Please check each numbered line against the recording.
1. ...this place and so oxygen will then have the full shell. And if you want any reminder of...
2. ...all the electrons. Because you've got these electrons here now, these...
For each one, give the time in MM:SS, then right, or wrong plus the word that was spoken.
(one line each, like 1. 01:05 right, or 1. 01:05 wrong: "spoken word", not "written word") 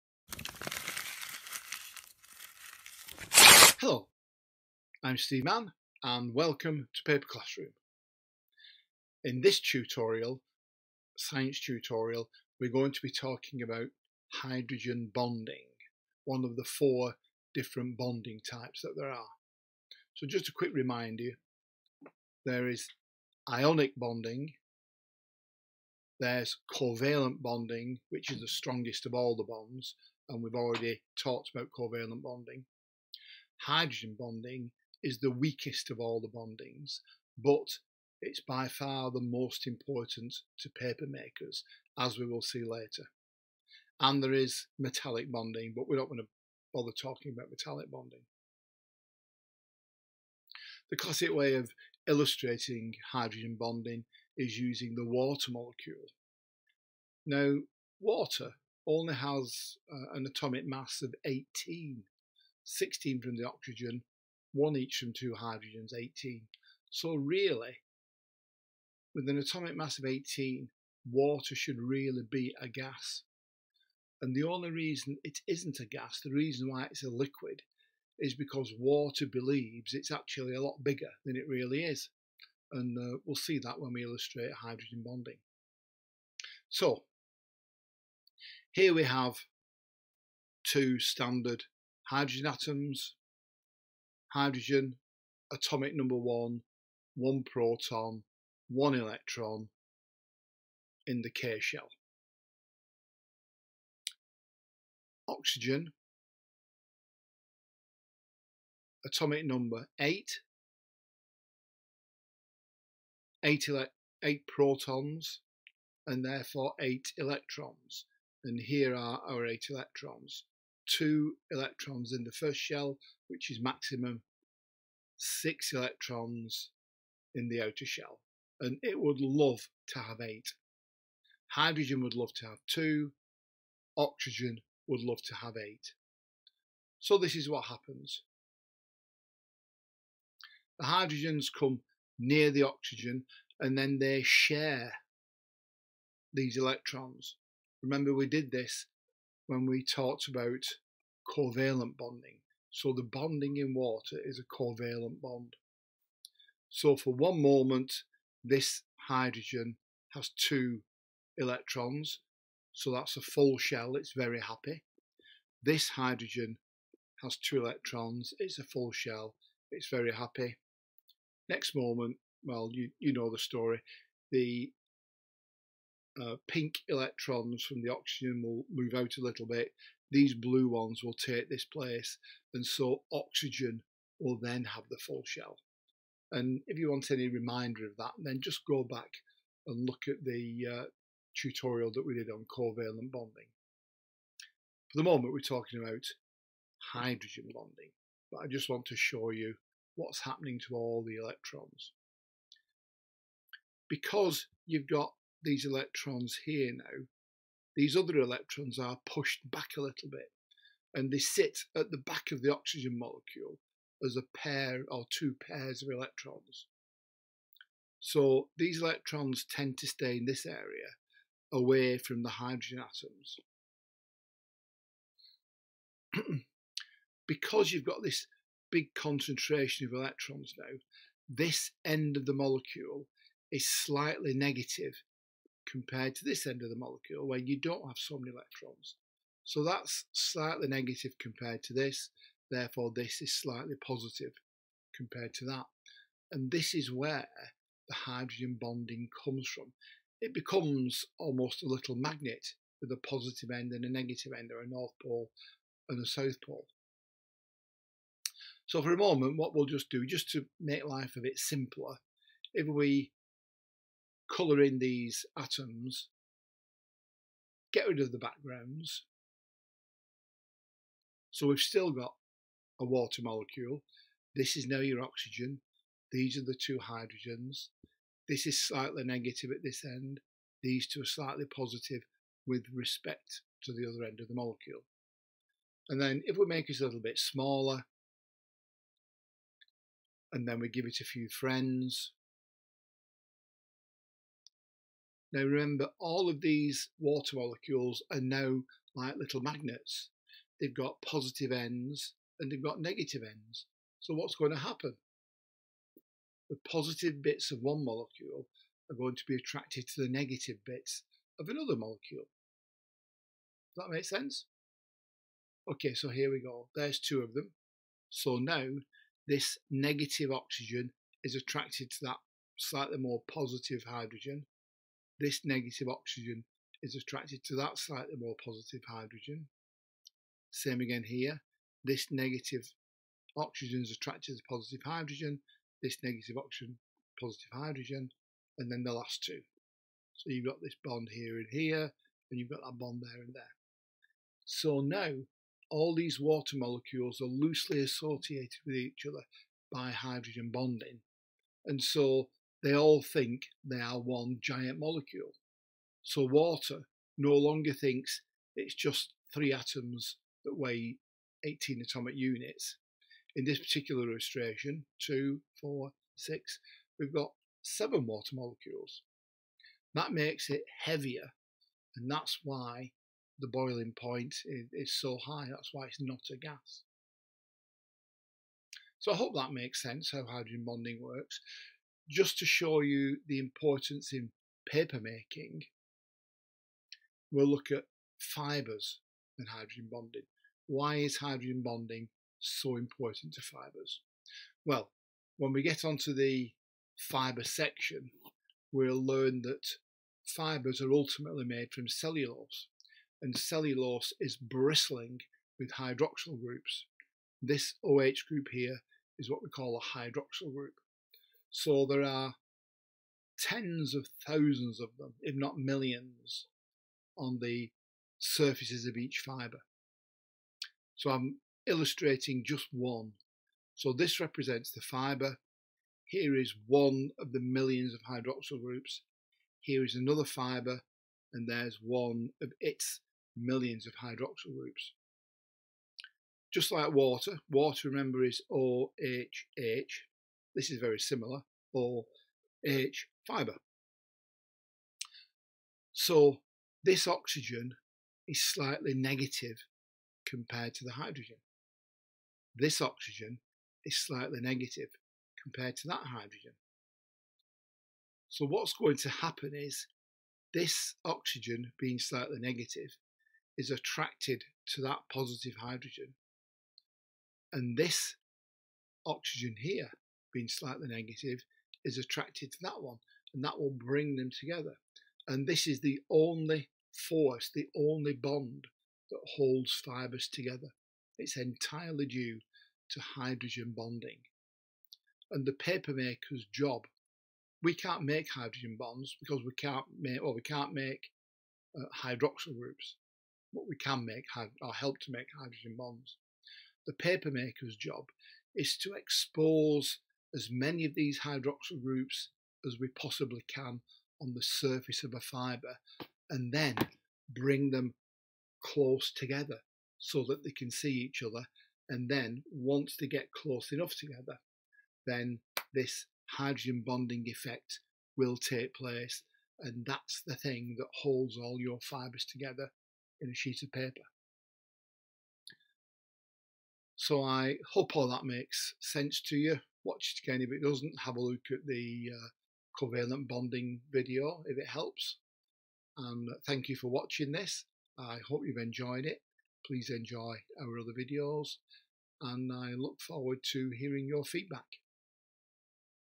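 1. 03:01 right
2. 03:20 right.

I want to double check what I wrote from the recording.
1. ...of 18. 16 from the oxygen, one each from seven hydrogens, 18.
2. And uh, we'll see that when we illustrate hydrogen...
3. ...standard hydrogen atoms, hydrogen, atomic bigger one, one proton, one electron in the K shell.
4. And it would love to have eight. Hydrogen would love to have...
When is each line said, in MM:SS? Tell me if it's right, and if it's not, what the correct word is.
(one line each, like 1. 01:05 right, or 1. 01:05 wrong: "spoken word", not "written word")
1. 01:01 wrong: "two", not "seven"
2. 01:22 right
3. 01:30 wrong: "number", not "bigger"
4. 02:08 right.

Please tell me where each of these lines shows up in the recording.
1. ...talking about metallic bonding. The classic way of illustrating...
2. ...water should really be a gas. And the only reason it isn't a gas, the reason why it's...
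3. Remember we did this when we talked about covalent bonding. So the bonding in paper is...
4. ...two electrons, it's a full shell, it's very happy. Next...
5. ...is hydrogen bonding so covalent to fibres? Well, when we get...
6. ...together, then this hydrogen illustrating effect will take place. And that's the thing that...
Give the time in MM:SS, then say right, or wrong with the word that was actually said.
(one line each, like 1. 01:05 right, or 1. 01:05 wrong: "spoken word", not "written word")
1. 00:46 right
2. 01:11 right
3. 02:27 wrong: "water", not "paper"
4. 02:47 right
5. 06:30 wrong: "important", not "covalent"
6. 08:33 wrong: "bonding", not "illustrating".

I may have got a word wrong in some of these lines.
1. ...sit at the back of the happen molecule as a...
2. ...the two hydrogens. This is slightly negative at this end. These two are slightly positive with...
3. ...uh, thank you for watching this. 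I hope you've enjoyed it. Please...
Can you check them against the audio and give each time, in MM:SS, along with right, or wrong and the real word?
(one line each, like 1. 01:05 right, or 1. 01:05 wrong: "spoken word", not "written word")
1. 03:31 wrong: "oxygen", not "happen"
2. 04:36 right
3. 08:56 right.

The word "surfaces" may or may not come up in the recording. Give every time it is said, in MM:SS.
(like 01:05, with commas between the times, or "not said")
06:58, 08:24.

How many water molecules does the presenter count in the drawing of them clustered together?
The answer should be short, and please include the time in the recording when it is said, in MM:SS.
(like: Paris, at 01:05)
7, at 06:07.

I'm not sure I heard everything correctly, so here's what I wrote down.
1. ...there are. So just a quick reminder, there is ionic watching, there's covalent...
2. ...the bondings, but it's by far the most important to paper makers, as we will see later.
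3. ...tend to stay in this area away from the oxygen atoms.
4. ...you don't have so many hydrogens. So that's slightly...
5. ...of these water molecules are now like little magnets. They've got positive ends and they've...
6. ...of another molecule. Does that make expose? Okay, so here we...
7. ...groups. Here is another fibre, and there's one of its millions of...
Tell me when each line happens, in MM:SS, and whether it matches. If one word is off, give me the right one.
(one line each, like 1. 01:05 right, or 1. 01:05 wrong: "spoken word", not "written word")
1. 00:18 wrong: "bonding", not "watching"
2. 00:36 right
3. 03:39 wrong: "hydrogen", not "oxygen"
4. 03:57 wrong: "electrons", not "hydrogens"
5. 04:56 right
6. 05:11 wrong: "sense", not "expose"
7. 07:08 right.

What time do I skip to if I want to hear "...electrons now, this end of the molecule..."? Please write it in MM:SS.
03:49.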